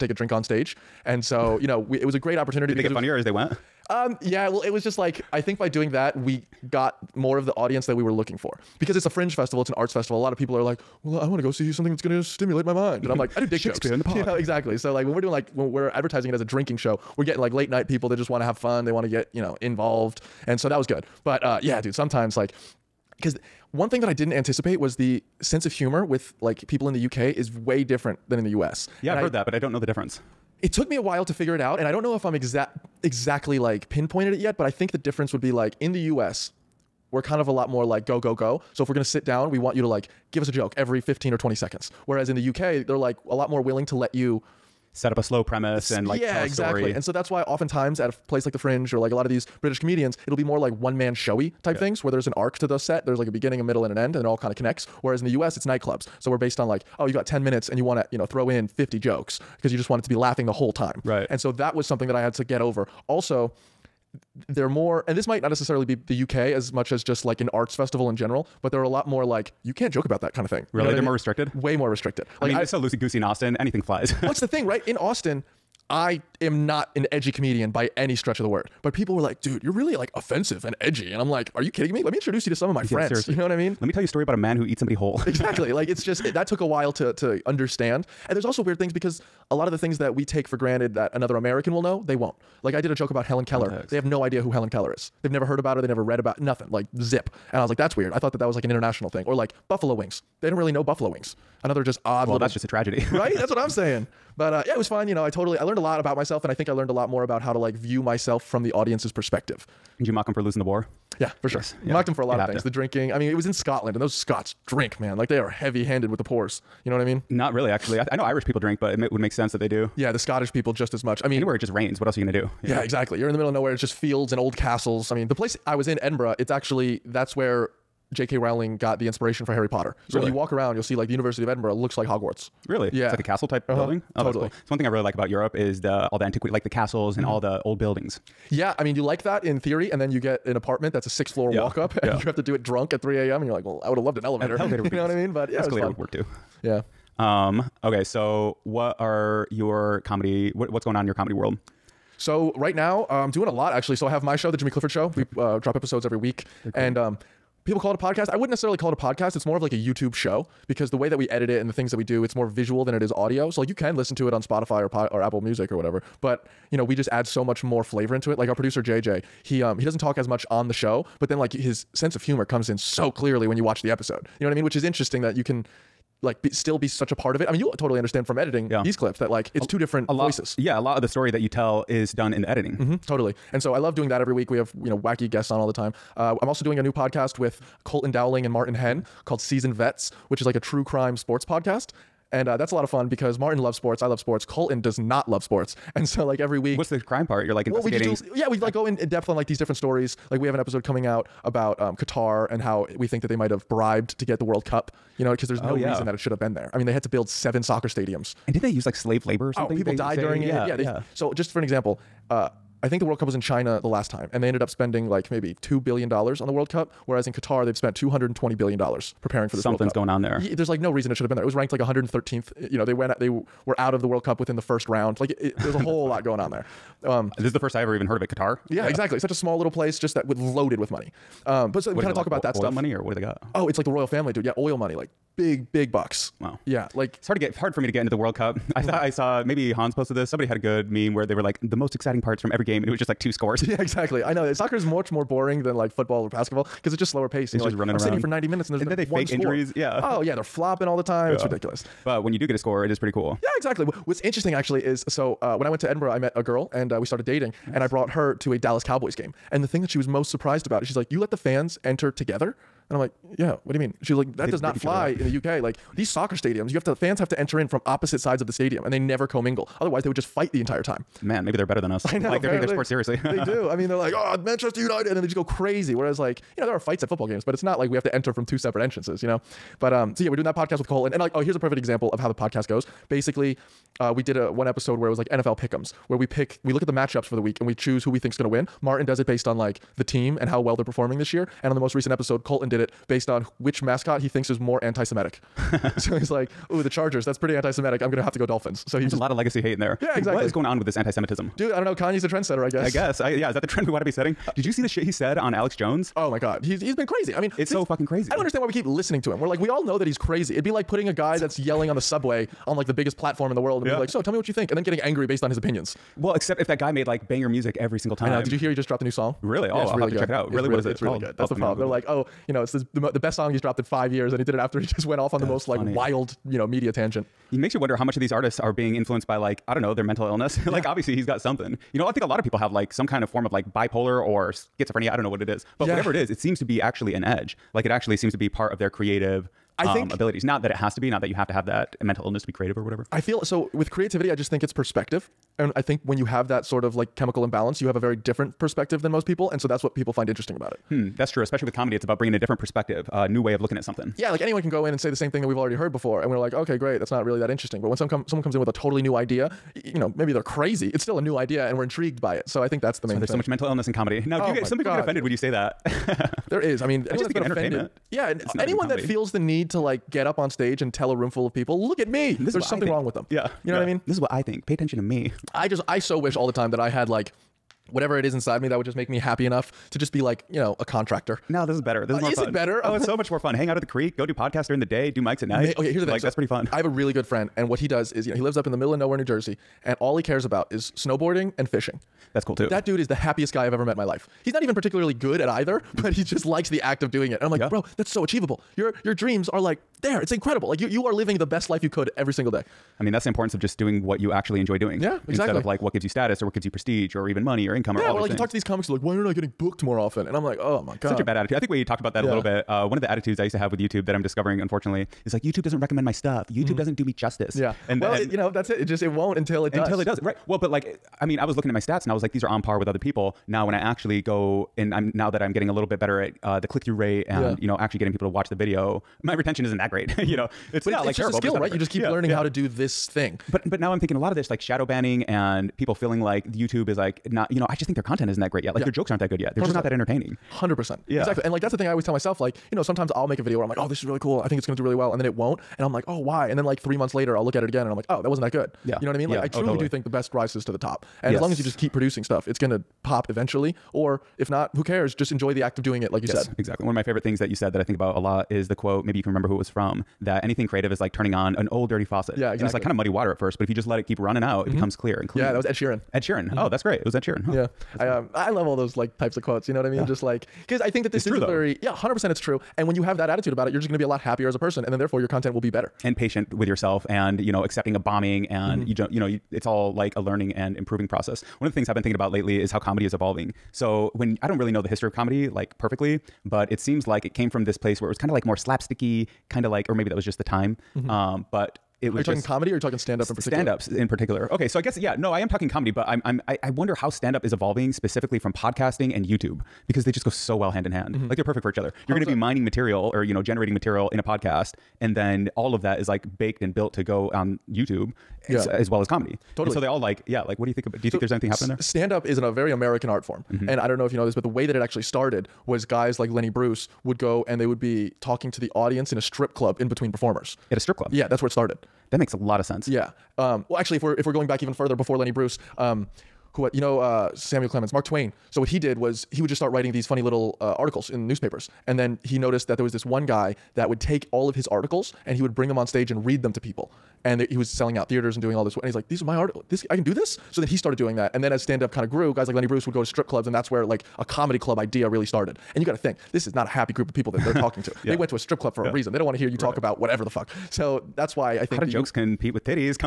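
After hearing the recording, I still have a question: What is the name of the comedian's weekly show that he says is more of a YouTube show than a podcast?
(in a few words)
The Jimmy Clifford Show.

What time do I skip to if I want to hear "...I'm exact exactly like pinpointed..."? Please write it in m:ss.
0:32.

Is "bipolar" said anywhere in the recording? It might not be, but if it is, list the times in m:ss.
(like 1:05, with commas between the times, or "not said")
5:33.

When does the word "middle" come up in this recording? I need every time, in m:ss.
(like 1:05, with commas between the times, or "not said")
0:53, 2:03, 6:28.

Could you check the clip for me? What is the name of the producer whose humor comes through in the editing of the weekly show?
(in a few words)
JJ.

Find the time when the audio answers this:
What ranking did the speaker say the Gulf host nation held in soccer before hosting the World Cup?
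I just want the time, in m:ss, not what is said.
3:41.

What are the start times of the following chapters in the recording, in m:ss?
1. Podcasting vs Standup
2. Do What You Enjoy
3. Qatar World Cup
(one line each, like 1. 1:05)
1. 8:34
2. 5:31
3. 2:27.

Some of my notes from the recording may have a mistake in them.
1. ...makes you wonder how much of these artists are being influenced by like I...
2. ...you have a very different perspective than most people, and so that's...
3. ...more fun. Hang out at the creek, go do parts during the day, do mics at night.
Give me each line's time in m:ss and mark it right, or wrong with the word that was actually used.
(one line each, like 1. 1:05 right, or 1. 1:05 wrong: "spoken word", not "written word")
1. 5:27 right
2. 5:47 right
3. 6:23 wrong: "podcasts", not "parts".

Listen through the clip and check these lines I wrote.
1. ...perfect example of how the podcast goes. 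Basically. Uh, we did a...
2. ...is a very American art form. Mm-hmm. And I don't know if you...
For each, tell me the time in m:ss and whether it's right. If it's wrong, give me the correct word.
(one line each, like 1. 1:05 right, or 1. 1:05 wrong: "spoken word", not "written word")
1. 4:41 right
2. 8:32 right.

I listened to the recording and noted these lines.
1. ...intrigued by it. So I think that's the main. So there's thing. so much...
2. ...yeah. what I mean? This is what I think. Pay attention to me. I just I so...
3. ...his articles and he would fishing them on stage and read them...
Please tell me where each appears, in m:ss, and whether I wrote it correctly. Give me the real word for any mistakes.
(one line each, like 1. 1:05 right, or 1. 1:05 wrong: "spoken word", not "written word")
1. 6:01 right
2. 6:13 right
3. 8:54 wrong: "bring", not "fishing".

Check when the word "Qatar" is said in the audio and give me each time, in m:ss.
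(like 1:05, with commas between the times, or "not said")
3:21, 3:37, 3:48.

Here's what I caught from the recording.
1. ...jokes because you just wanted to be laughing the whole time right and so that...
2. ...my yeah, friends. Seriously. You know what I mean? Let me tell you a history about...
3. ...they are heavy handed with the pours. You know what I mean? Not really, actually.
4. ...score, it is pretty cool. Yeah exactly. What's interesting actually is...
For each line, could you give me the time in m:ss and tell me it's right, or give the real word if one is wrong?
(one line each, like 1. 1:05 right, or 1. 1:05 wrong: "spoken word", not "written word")
1. 0:58 right
2. 1:22 wrong: "story", not "history"
3. 1:55 right
4. 4:12 right.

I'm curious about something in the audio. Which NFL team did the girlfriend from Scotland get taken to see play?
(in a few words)
Dallas Cowboys.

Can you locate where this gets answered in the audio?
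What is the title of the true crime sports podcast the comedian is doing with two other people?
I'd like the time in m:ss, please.
3:09.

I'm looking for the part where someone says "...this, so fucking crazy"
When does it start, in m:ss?
5:07.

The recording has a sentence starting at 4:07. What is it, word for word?
And just like, running I'm around.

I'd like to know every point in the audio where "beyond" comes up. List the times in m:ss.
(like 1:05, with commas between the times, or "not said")
not said.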